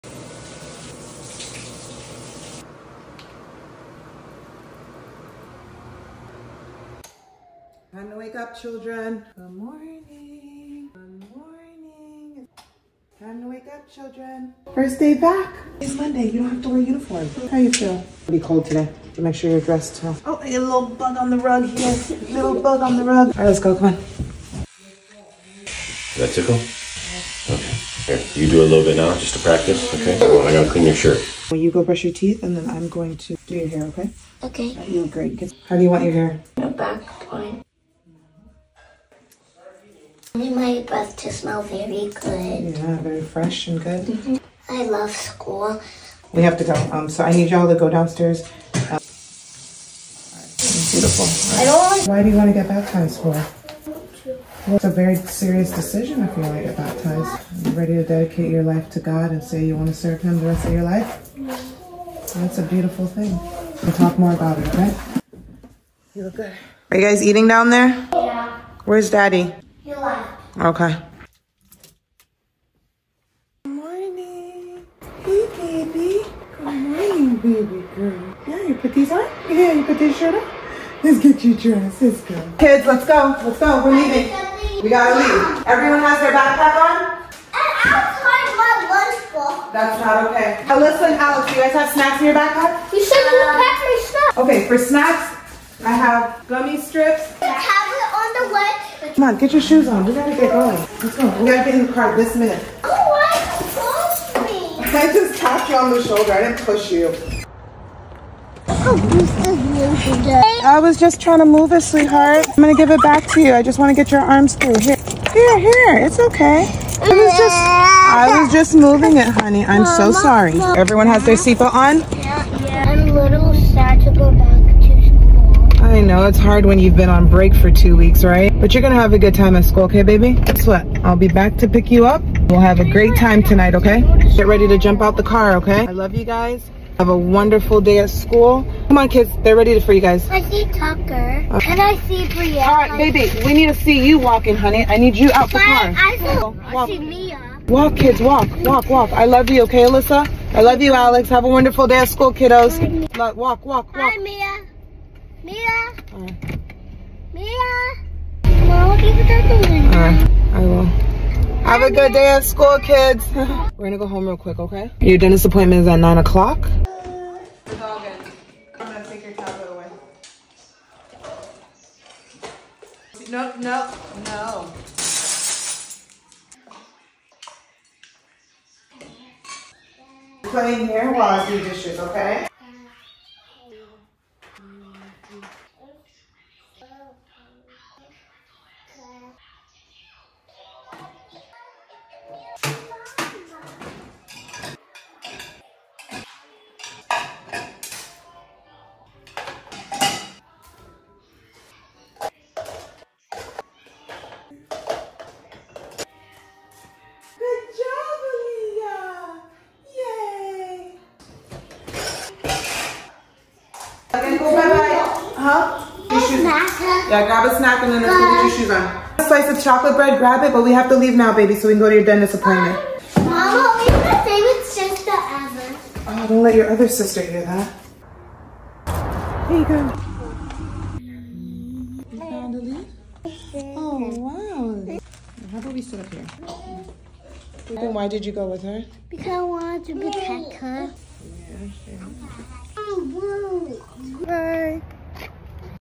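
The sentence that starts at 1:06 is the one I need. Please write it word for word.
Are you guys eating down there?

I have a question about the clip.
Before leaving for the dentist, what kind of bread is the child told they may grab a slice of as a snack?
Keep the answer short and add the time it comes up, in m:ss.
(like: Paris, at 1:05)
chocolate bread, at 3:39.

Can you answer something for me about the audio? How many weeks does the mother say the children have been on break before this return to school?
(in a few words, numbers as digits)
2.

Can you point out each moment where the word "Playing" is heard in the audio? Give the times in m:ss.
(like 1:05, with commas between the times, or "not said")
3:00.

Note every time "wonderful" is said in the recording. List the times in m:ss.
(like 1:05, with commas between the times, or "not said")
2:17, 2:31.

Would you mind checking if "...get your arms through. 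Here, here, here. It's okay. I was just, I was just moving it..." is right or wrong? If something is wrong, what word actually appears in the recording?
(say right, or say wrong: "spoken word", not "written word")
right.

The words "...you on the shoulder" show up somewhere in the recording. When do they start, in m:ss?
1:45.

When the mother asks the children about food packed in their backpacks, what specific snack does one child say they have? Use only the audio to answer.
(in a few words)
gummy strips.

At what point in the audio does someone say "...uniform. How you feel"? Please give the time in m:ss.
0:16.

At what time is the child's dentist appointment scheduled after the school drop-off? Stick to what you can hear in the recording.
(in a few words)
9 o'clock.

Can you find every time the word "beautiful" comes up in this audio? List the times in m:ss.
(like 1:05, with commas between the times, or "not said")
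0:50, 1:02.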